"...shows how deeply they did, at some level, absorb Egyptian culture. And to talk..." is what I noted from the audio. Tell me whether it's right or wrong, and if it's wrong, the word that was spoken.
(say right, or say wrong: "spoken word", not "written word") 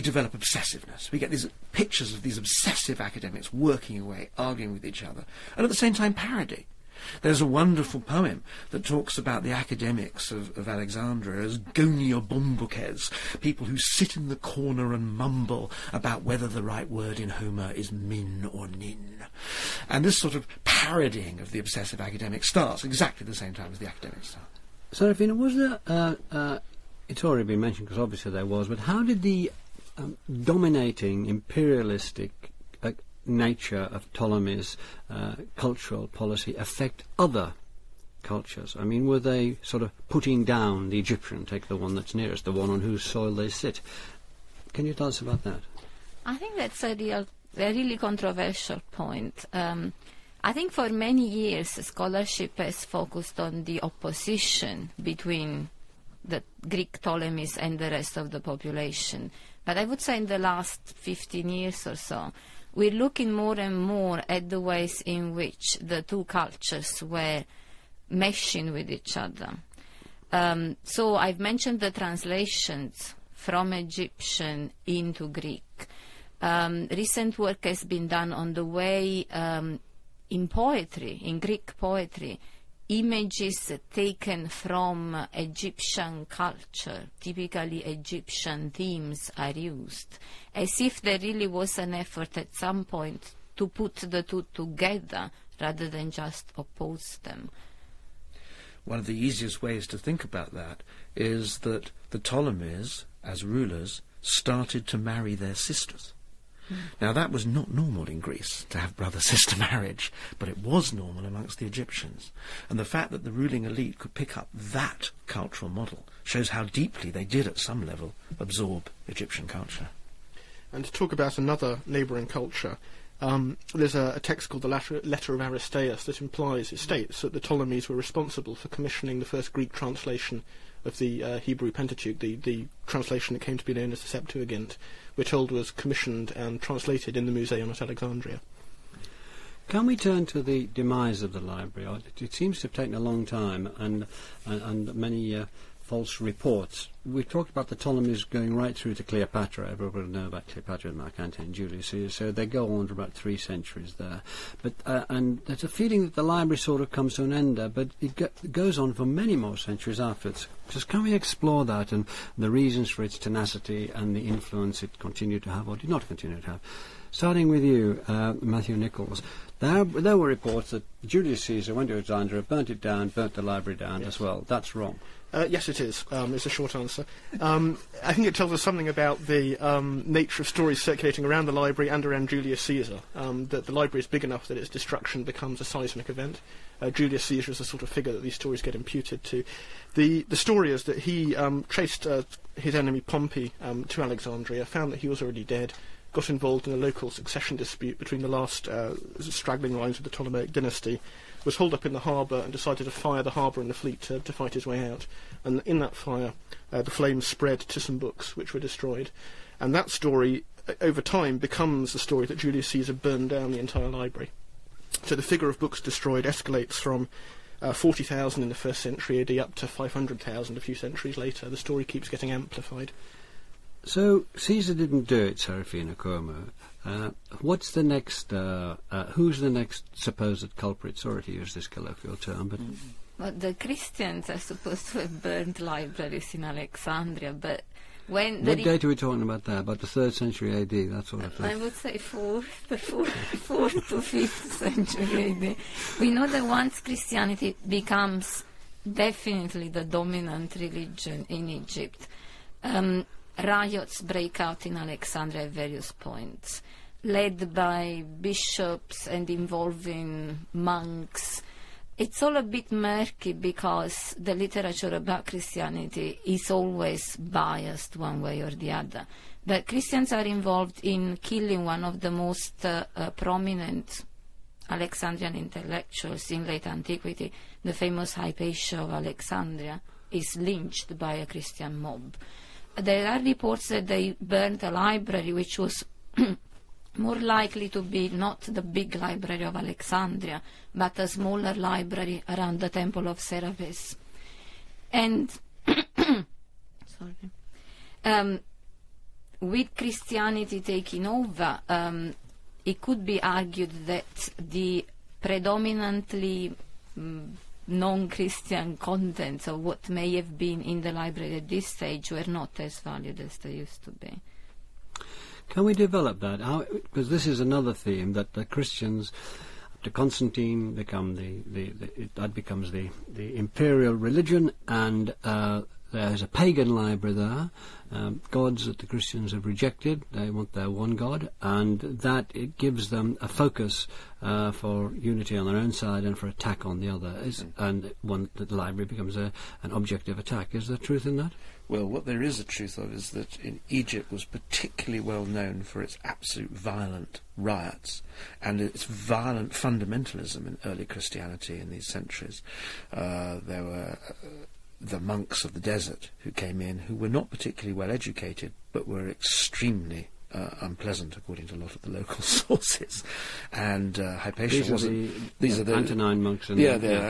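right.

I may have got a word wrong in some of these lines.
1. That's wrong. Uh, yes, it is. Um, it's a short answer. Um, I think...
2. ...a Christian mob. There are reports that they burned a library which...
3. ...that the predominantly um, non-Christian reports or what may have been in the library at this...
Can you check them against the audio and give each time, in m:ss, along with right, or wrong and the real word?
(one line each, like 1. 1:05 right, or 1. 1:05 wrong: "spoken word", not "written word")
1. 2:54 right
2. 4:41 right
3. 5:03 wrong: "contents", not "reports".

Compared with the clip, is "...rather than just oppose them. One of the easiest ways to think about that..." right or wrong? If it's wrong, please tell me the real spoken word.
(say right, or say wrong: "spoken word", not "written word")
right.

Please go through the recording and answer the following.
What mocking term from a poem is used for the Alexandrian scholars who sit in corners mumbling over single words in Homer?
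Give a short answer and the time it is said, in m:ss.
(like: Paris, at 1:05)
goniabombukes, at 0:11.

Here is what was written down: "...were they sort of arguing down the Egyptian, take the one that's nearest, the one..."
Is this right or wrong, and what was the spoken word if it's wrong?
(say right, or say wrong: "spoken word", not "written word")
wrong: "putting", not "arguing".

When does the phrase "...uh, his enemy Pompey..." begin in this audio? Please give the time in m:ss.
3:12.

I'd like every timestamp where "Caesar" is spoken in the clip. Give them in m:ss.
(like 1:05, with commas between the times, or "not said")
2:31, 2:51, 3:02, 3:07, 3:32, 3:44.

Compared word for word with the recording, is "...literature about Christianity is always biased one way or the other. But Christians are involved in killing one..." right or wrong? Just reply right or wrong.
right.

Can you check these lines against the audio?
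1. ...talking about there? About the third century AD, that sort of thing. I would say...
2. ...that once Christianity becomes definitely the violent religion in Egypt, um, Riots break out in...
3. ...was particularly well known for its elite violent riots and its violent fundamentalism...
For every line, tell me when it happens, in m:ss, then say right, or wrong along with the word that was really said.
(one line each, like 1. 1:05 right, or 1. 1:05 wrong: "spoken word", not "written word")
1. 3:58 right
2. 4:06 wrong: "dominant", not "violent"
3. 5:44 wrong: "absolute", not "elite".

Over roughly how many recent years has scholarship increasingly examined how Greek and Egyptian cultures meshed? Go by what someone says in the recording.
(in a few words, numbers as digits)
15.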